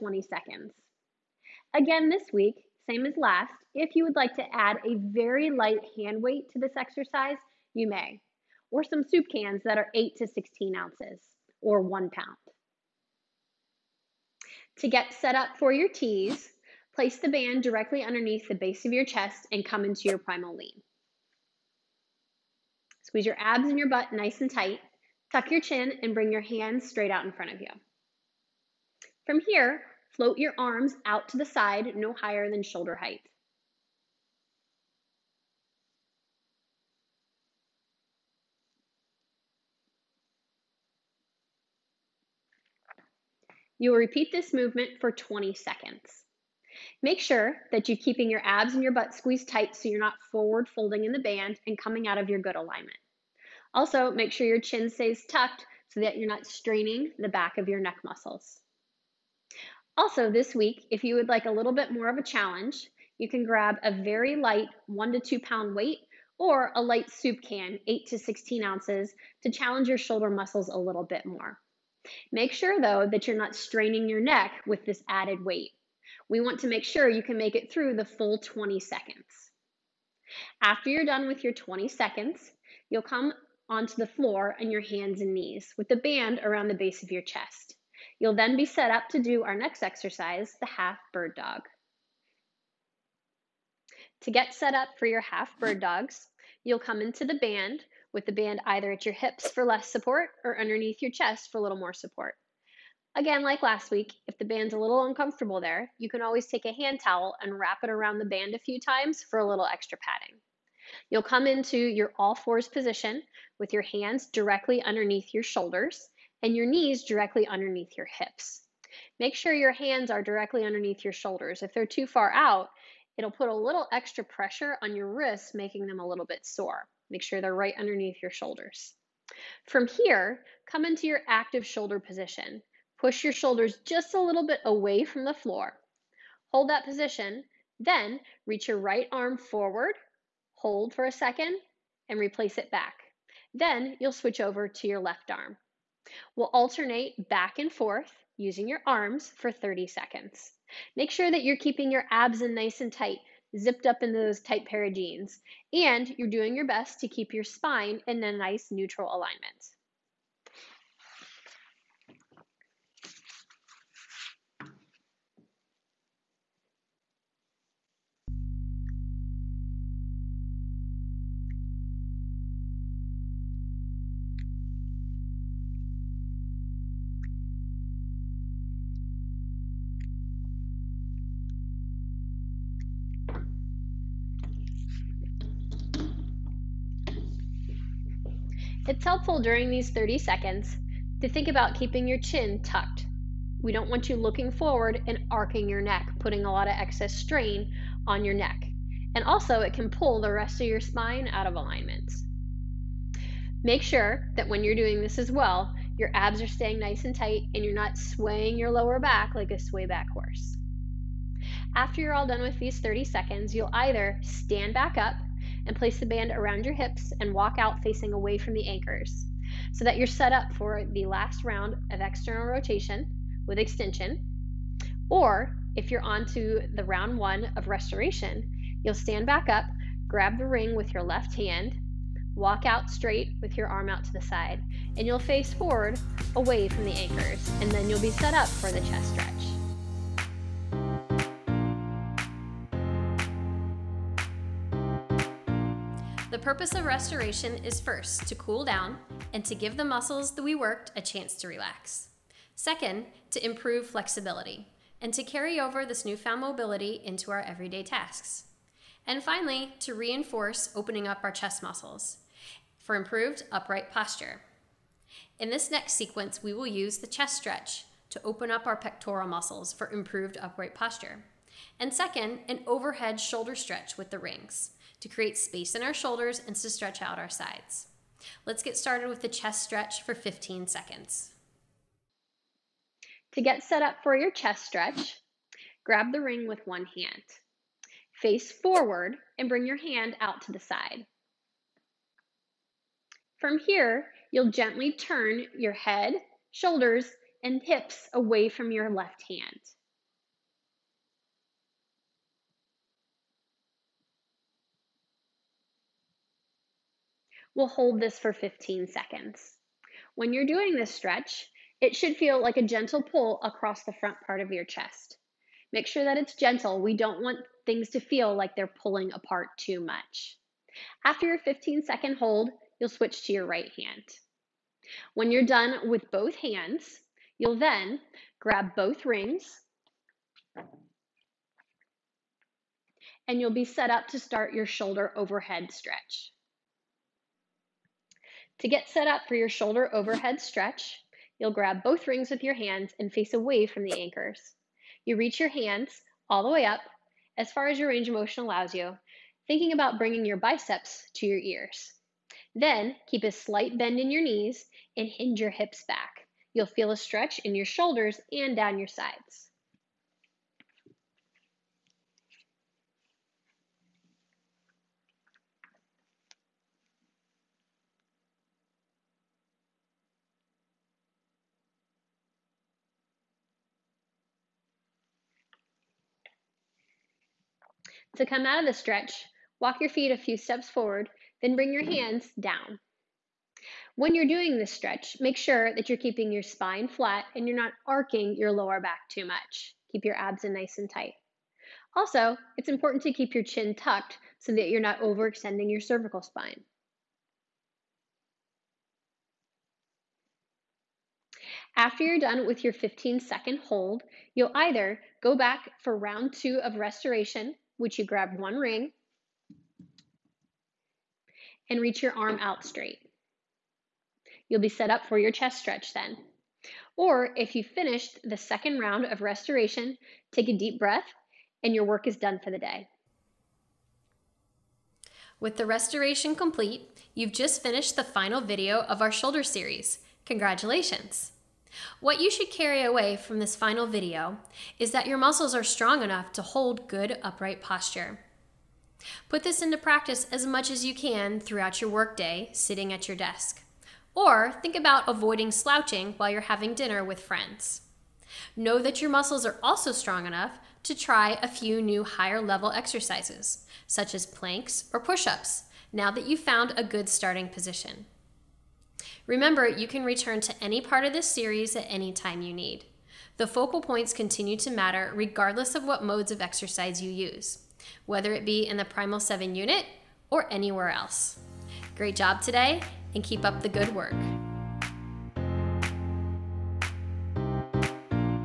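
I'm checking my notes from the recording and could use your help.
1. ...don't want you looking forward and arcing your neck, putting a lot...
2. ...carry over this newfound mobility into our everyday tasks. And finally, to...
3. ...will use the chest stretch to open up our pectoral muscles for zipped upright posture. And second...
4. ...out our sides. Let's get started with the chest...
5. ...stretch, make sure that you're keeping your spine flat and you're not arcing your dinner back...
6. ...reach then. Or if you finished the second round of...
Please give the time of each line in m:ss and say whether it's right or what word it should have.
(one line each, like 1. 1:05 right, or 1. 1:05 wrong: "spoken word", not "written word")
1. 3:13 right
2. 4:15 right
3. 4:26 wrong: "improved", not "zipped"
4. 4:36 right
5. 6:24 wrong: "lower", not "dinner"
6. 6:55 wrong: "stretch", not "reach".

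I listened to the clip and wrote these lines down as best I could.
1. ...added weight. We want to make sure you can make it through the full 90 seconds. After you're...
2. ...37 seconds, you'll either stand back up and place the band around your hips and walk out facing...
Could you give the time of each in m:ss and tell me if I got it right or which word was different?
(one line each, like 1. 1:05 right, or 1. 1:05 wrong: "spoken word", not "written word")
1. 1:15 wrong: "20", not "90"
2. 3:32 wrong: "30", not "37".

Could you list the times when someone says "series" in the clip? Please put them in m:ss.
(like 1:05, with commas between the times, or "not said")
7:09, 7:41.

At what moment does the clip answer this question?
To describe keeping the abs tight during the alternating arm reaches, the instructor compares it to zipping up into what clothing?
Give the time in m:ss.
2:34.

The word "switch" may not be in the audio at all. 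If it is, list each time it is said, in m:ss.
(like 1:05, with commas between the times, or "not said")
2:24, 5:22.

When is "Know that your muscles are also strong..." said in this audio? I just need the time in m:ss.
7:28.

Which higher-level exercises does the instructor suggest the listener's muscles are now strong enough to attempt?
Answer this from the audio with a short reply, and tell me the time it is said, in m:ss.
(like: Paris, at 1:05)
planks or push ups, at 7:34.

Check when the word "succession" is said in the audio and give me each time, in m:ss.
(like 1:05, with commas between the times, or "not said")
not said.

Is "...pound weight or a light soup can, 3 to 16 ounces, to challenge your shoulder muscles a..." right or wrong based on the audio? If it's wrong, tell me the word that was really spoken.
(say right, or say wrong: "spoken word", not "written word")
wrong: "8", not "3".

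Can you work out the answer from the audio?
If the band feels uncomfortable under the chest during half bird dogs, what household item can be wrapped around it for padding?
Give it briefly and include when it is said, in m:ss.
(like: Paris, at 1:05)
hand towel, at 1:46.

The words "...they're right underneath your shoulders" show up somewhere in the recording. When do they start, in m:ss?
2:07.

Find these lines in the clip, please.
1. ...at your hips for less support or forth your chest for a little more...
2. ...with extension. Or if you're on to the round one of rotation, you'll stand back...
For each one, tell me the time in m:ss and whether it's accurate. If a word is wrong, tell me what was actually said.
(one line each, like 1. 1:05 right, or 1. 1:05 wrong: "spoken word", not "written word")
1. 1:38 wrong: "underneath", not "forth"
2. 3:43 wrong: "restoration", not "rotation".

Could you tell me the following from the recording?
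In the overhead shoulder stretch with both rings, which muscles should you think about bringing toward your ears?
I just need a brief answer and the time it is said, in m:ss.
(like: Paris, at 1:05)
biceps, at 5:50.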